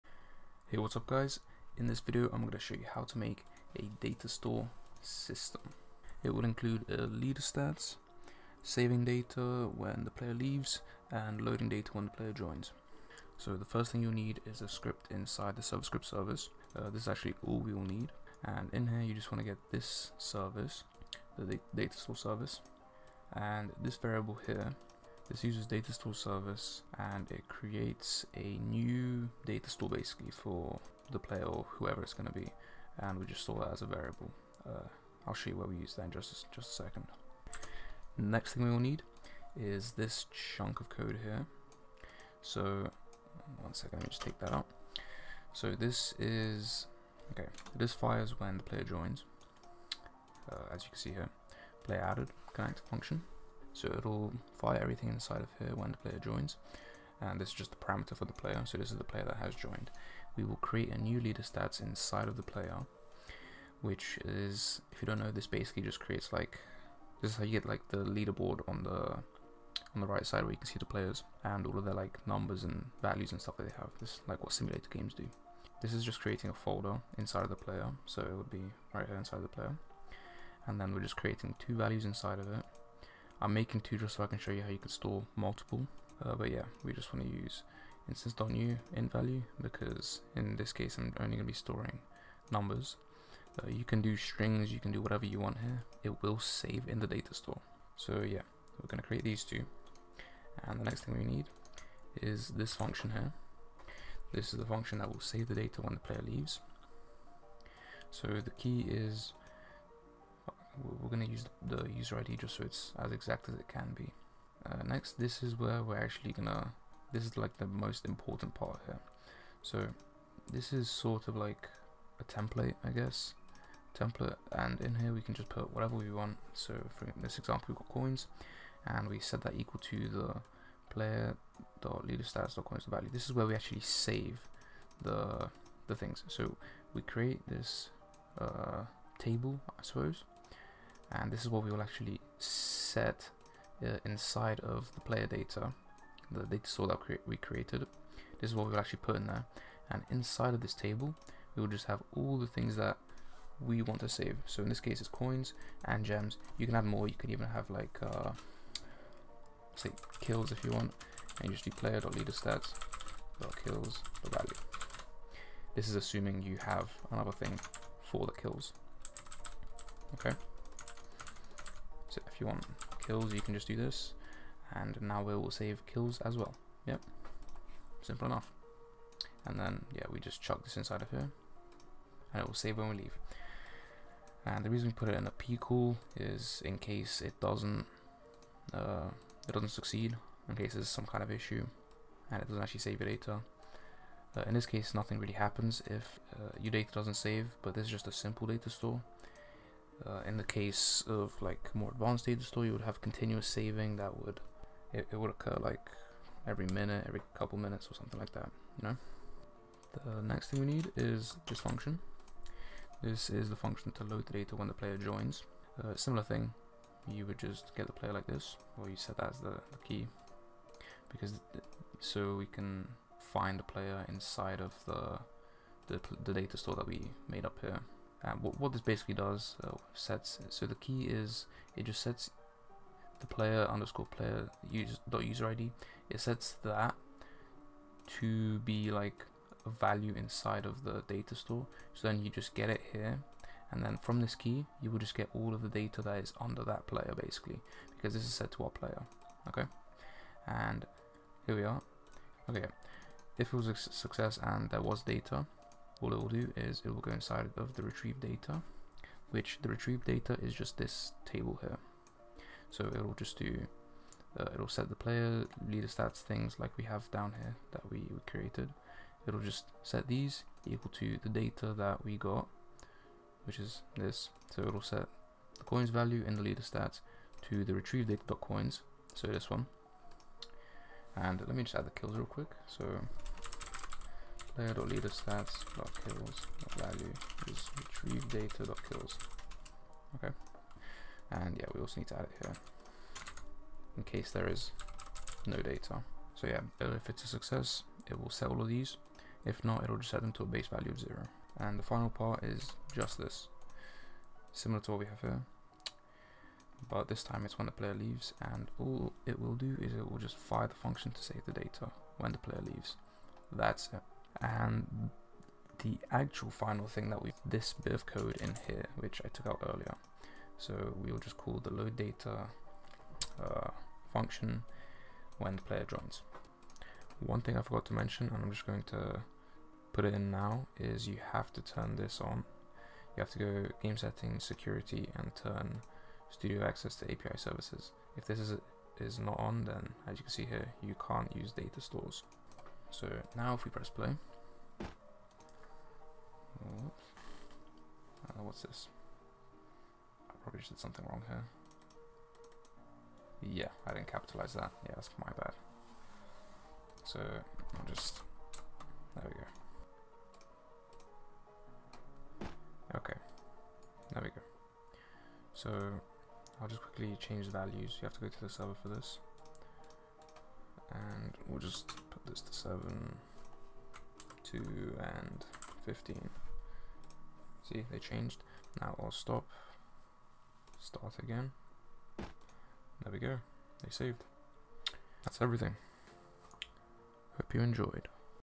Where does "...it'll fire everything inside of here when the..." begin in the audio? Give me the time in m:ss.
0:53.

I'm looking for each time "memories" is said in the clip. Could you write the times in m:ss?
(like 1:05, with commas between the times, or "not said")
not said.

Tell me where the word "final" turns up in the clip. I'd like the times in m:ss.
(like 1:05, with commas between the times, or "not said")
5:01, 5:16.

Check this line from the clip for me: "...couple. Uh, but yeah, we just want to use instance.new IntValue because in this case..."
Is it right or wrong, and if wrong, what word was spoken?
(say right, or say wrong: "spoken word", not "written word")
wrong: "multiple", not "couple".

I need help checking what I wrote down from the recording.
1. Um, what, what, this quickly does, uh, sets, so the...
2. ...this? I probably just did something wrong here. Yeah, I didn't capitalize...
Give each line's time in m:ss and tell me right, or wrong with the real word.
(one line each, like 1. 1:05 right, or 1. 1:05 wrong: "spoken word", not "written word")
1. 3:48 wrong: "basically", not "quickly"
2. 5:48 right.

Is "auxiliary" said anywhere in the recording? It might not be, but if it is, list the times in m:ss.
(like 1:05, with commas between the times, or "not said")
not said.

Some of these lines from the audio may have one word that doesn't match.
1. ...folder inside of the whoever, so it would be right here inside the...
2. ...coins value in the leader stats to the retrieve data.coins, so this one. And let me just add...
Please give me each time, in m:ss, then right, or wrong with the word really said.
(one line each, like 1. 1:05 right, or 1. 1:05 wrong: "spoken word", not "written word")
1. 1:16 wrong: "player", not "whoever"
2. 4:35 right.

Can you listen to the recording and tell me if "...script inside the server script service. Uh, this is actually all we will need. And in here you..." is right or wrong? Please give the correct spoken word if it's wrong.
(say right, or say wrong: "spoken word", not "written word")
right.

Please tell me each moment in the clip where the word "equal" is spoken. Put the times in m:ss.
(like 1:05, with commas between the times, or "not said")
2:09, 4:30.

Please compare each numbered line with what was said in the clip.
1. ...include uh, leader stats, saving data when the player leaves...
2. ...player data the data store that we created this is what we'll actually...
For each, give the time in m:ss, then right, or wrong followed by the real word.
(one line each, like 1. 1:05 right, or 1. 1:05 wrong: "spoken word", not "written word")
1. 0:06 right
2. 2:25 right.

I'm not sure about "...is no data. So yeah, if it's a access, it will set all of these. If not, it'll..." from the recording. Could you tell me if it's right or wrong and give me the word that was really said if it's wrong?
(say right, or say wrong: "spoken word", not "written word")
wrong: "success", not "access".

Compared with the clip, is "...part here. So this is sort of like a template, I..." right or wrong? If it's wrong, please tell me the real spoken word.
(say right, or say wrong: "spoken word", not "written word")
right.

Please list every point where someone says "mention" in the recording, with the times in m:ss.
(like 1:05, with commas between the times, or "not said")
5:27.